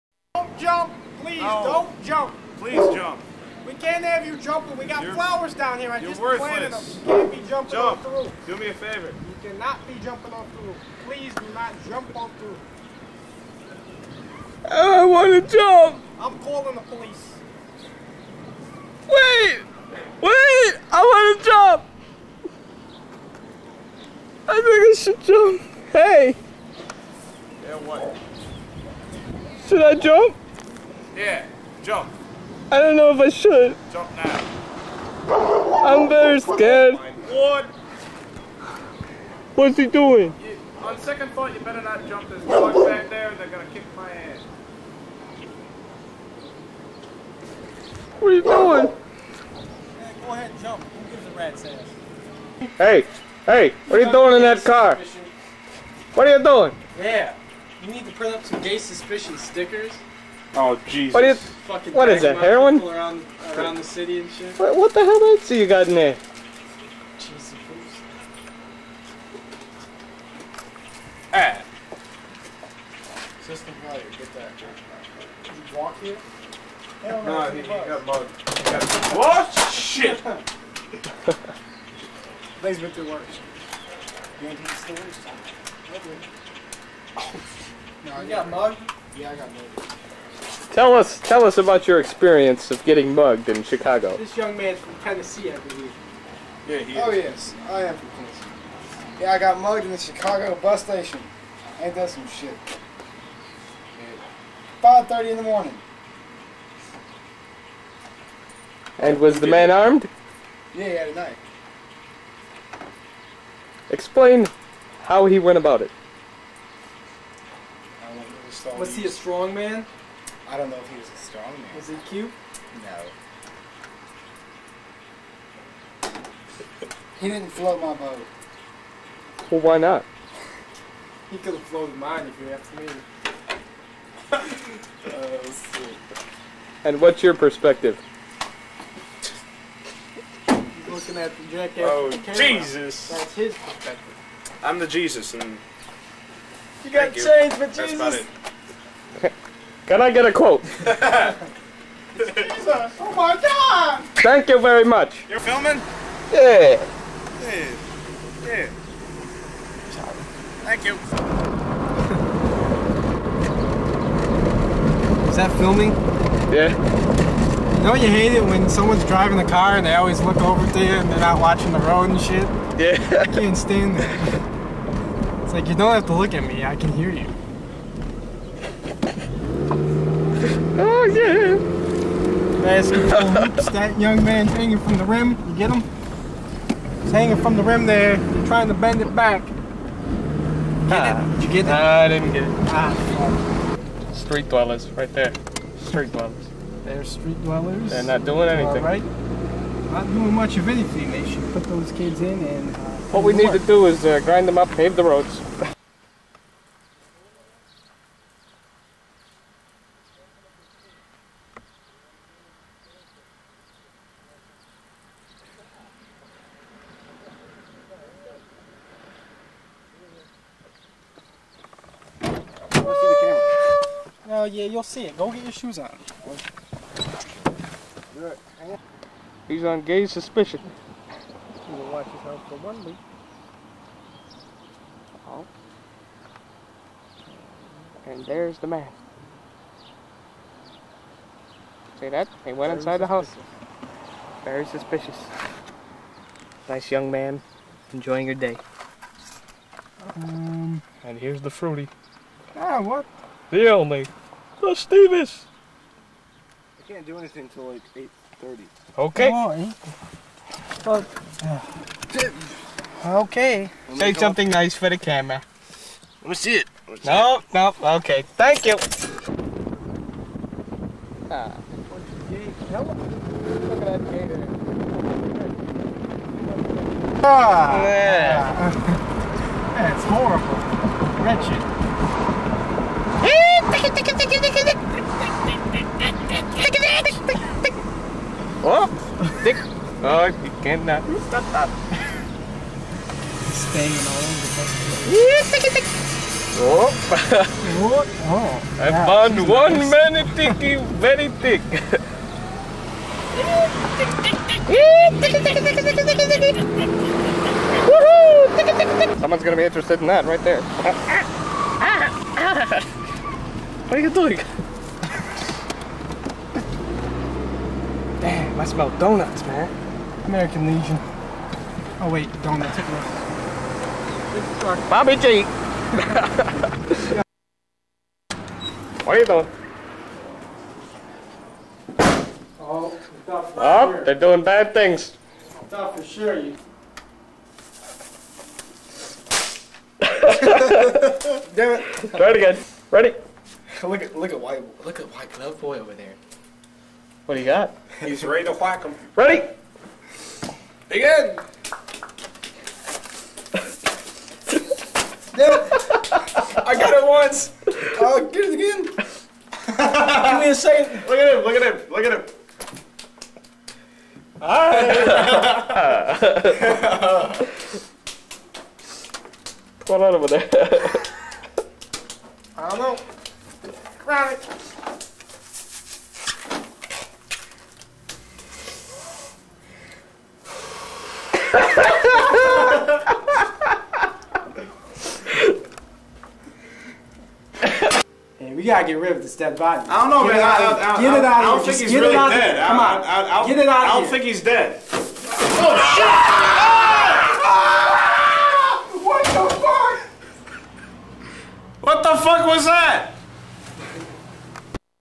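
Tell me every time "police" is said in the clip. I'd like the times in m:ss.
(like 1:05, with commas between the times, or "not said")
0:16.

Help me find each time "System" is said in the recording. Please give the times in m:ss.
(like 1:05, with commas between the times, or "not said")
1:13.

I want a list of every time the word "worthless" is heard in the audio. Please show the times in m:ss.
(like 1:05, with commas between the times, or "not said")
0:06.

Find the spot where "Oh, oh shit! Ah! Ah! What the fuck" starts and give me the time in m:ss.
6:34.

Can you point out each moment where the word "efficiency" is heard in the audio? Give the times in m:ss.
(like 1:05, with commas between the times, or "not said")
not said.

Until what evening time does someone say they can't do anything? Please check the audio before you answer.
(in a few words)
8:30.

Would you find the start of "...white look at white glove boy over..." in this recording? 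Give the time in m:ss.
5:44.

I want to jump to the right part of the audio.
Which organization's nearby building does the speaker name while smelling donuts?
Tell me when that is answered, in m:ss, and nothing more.
5:20.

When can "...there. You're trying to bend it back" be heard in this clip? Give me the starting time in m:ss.
3:07.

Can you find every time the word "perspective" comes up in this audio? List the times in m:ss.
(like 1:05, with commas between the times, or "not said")
2:17, 2:23.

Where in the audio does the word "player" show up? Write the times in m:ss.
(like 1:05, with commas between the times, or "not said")
1:13.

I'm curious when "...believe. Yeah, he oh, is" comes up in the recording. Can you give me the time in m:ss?
1:35.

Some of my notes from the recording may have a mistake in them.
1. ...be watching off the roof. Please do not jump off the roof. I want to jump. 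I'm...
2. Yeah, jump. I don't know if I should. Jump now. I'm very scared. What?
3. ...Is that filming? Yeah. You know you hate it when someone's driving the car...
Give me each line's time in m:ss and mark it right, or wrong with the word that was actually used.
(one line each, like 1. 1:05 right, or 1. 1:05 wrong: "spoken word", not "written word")
1. 0:09 wrong: "jumping", not "watching"
2. 0:31 right
3. 2:45 right.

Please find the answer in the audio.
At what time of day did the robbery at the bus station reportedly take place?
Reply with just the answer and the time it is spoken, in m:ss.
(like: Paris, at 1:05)
5:30 in the morning, at 1:44.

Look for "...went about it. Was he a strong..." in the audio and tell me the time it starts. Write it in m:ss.
1:55.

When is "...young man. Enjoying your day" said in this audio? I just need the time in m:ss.
4:06.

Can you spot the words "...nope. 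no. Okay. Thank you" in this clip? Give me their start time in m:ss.
4:27.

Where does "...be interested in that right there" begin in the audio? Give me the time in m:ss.
5:09.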